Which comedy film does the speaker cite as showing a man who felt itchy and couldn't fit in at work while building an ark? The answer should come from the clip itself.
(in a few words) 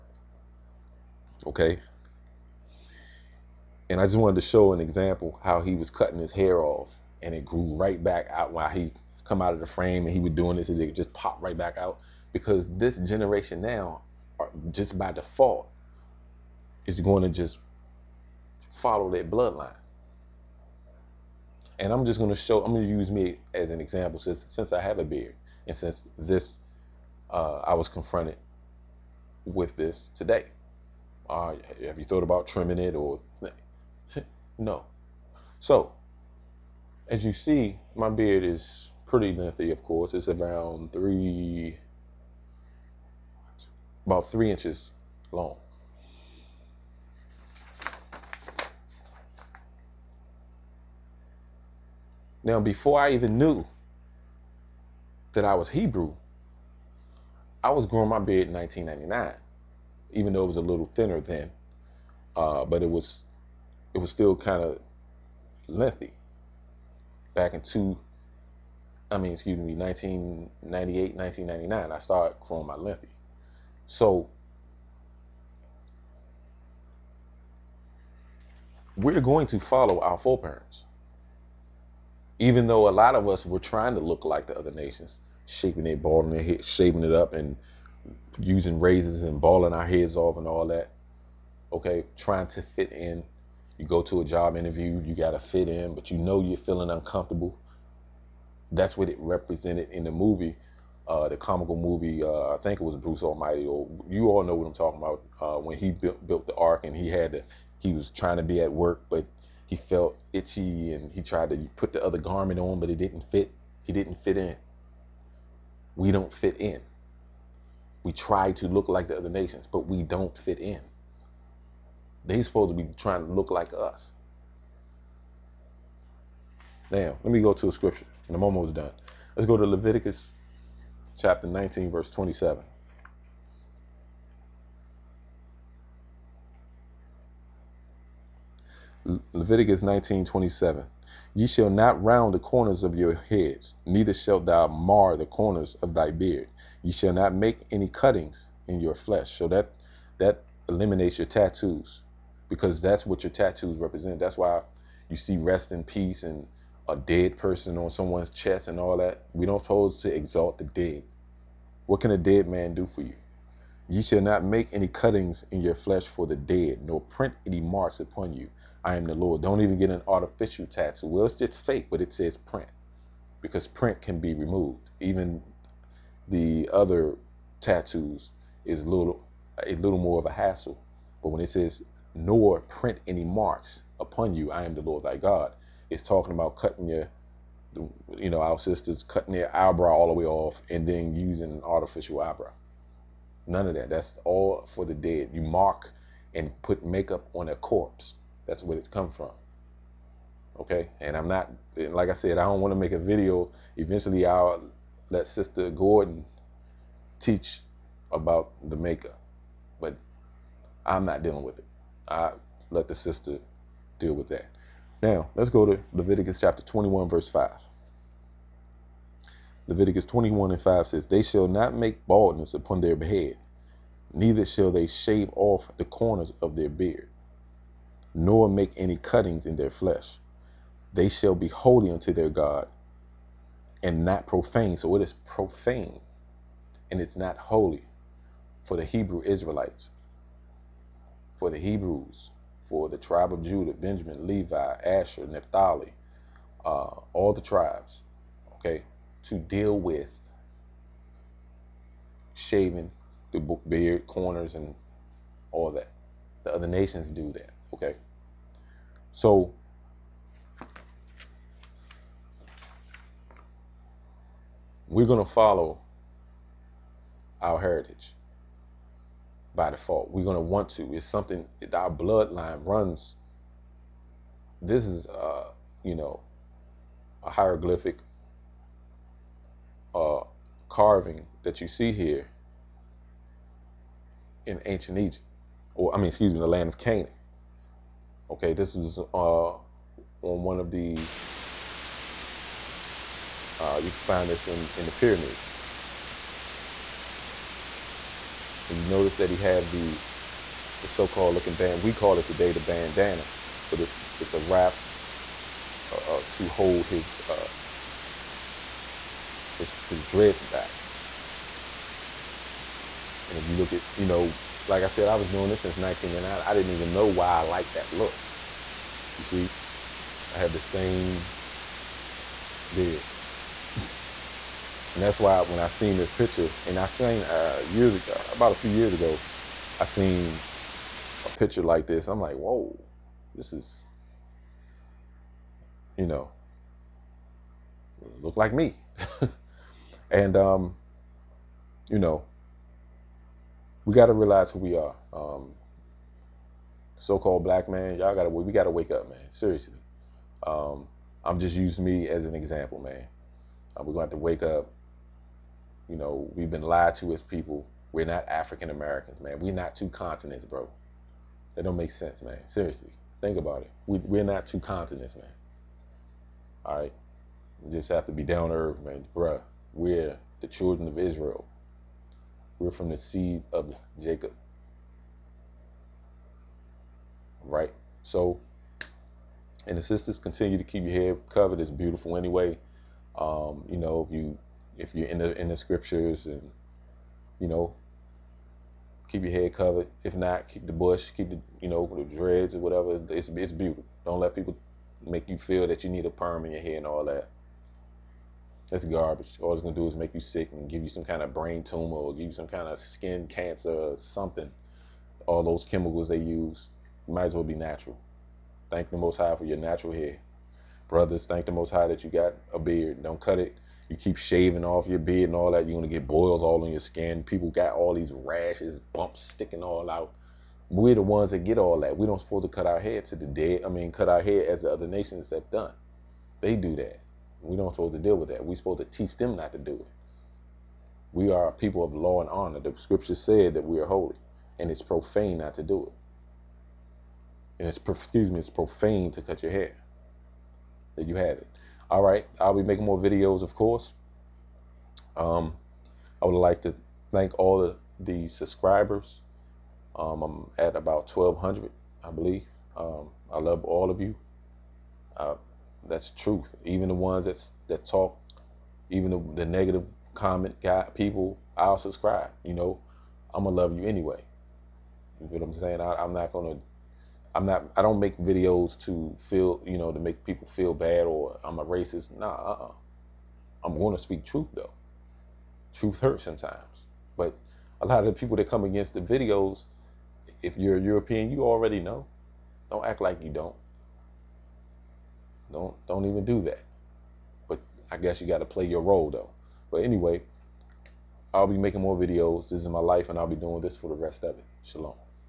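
Bruce Almighty.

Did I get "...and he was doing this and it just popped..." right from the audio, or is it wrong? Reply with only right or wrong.
right.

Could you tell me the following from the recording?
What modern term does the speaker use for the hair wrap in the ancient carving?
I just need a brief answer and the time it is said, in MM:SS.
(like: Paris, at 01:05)
bandana, at 05:02.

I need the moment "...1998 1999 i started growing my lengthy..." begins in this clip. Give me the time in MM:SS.
01:09.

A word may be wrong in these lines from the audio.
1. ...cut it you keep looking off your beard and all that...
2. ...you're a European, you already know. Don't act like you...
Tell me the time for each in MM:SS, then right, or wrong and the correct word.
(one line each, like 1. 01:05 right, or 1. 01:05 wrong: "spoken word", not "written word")
1. 06:53 wrong: "shaving", not "looking"
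2. 08:00 right.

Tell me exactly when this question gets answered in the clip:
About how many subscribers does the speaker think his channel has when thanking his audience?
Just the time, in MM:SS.
07:31.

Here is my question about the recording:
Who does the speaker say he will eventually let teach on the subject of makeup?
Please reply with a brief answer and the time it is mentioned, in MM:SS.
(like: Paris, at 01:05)
Sister Gordon, at 03:25.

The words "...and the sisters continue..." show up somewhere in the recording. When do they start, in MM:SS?
06:19.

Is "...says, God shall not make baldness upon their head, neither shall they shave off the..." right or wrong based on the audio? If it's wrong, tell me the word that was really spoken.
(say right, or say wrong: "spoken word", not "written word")
wrong: "They", not "God".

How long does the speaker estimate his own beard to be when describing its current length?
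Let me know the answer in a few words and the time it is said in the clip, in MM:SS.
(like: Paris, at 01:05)
3 inches, at 00:44.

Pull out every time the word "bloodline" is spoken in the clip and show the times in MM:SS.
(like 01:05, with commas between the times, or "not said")
00:19, 04:31.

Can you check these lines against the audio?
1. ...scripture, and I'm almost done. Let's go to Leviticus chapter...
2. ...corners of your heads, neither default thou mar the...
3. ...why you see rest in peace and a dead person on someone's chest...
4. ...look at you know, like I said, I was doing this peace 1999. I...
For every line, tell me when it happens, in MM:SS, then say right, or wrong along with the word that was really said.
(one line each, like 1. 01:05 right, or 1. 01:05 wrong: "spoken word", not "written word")
1. 02:07 right
2. 02:22 wrong: "shalt", not "default"
3. 02:34 right
4. 05:13 wrong: "since", not "peace".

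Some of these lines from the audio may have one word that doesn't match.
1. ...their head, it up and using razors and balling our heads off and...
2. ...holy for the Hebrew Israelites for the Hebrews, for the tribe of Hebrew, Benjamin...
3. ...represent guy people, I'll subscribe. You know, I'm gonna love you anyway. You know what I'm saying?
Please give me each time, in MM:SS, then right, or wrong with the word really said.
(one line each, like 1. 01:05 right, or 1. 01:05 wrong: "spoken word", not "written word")
1. 01:26 right
2. 03:57 wrong: "Judah", not "Hebrew"
3. 07:40 wrong: "comment", not "represent".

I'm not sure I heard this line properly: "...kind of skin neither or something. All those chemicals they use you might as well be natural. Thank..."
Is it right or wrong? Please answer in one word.
wrong.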